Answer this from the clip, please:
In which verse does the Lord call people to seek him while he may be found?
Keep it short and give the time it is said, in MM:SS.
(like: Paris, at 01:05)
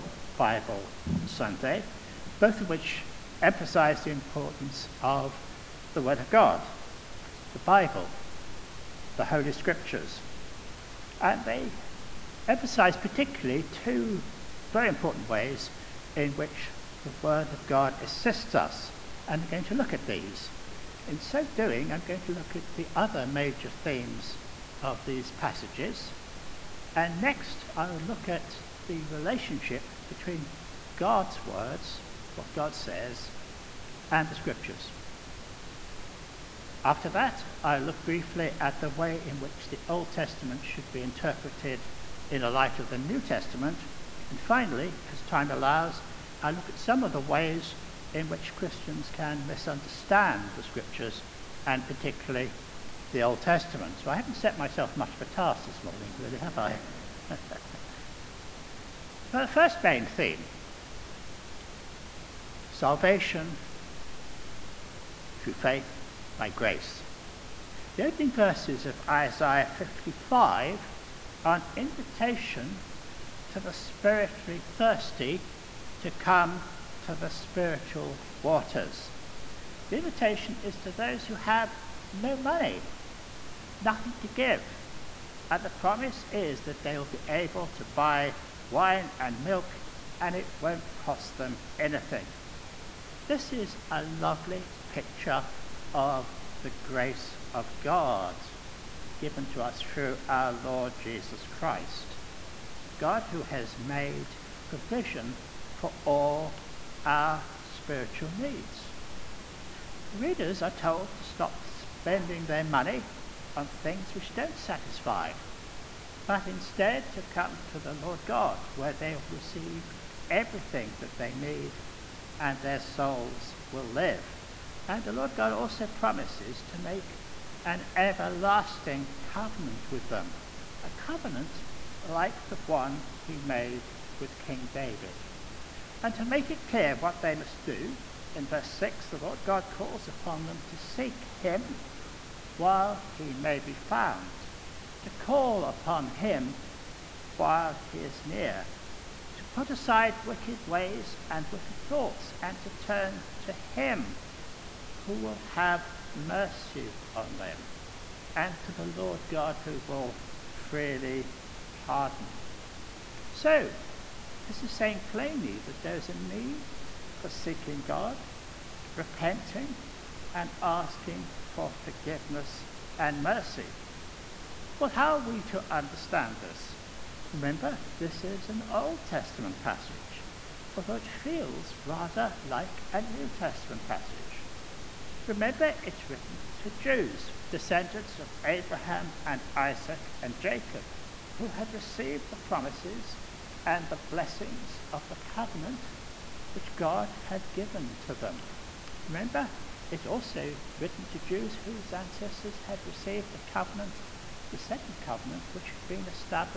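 Verse 6, at 02:18.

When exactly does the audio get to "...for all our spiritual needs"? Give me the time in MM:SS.
01:45.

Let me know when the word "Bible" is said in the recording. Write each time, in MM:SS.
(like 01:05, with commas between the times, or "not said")
00:00, 00:07.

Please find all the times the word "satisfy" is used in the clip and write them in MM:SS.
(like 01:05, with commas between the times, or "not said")
01:54.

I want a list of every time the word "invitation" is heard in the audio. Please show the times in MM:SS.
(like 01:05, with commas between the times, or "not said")
01:11, 01:19.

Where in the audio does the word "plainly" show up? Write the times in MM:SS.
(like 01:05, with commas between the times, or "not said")
02:45.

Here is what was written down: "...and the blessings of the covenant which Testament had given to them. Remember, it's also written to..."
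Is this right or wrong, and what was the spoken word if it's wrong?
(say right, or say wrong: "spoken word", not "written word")
wrong: "God", not "Testament".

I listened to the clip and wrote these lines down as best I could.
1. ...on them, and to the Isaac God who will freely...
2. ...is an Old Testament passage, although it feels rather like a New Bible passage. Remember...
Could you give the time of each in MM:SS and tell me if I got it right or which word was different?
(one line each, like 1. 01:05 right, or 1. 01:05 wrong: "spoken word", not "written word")
1. 02:37 wrong: "Lord", not "Isaac"
2. 02:58 wrong: "Testament", not "Bible".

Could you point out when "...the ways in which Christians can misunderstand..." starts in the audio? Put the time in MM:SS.
00:47.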